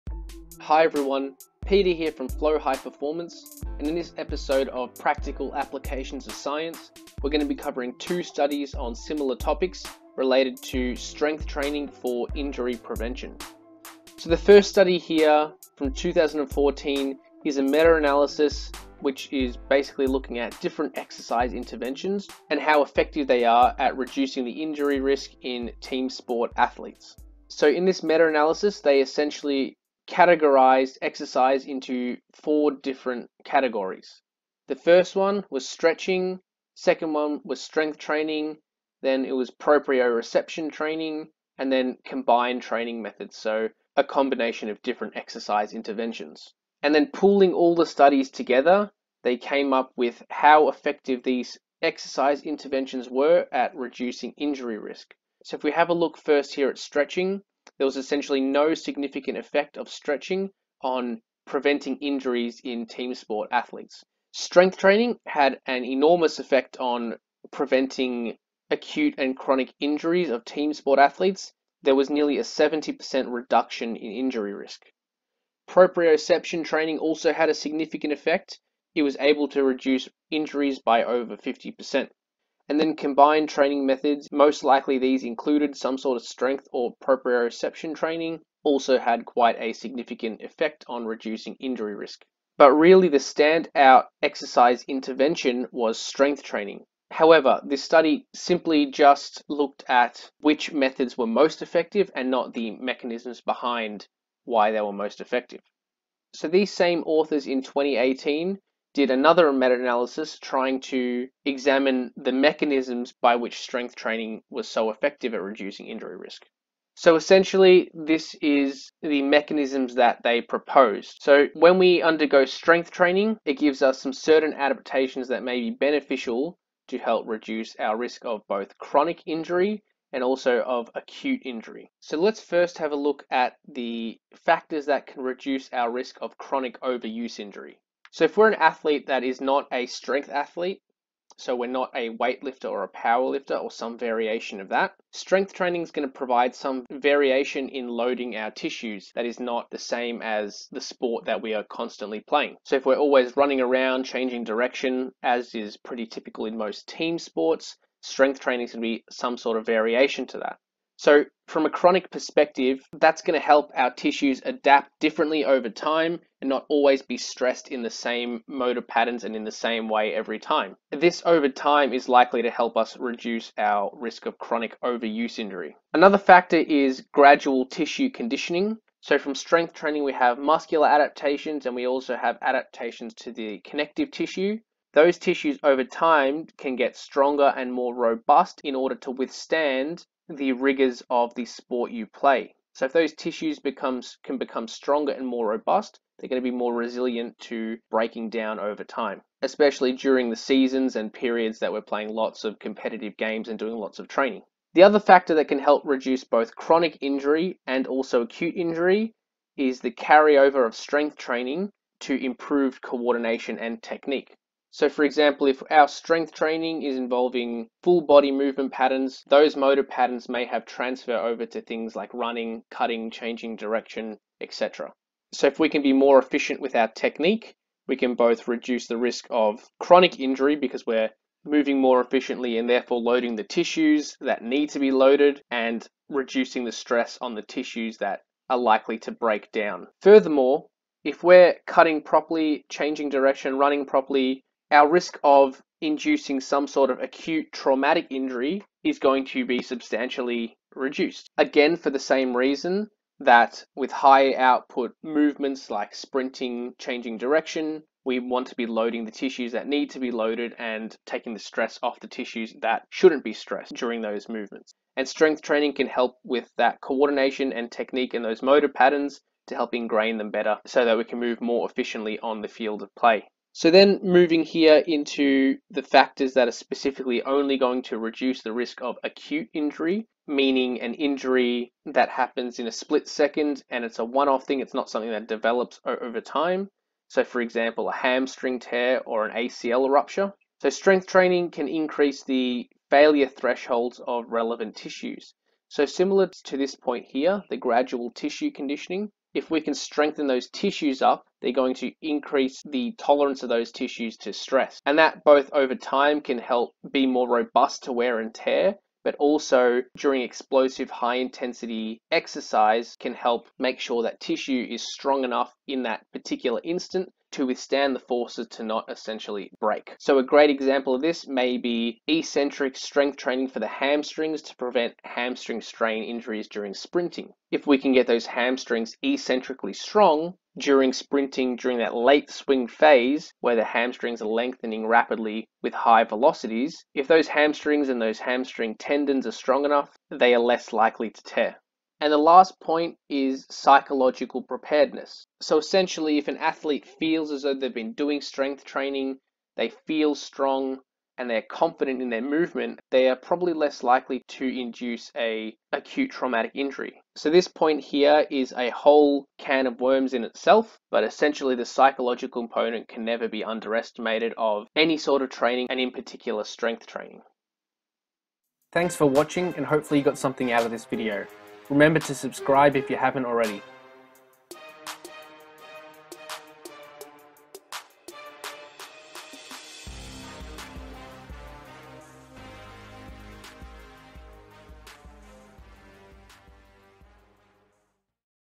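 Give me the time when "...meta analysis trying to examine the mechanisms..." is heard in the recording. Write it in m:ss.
1:49.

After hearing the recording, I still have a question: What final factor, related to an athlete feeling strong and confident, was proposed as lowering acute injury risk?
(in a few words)
Psychological preparedness.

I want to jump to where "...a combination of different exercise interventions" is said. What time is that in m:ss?
0:43.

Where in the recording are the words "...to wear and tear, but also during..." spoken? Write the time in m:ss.
5:07.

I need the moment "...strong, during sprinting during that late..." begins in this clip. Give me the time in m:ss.
5:29.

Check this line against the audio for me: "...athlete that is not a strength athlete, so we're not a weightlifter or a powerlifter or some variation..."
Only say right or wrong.
right.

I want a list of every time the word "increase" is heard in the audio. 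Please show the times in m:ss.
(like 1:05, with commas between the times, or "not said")
4:51, 5:02.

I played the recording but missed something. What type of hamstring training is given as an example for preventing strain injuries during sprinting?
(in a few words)
Eccentric strength training.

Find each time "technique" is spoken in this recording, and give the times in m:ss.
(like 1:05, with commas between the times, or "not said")
3:33, 3:46, 4:27.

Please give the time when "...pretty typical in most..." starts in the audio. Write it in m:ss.
2:35.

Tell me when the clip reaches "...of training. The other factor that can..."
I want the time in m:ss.
3:23.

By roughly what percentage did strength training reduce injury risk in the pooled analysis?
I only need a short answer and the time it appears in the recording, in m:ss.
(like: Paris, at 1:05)
70%, at 1:12.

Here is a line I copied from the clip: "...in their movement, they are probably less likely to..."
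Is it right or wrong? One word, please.
right.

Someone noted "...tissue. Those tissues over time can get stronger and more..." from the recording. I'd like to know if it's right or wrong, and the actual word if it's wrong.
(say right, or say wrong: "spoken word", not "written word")
right.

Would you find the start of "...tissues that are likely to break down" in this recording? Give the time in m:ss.
3:57.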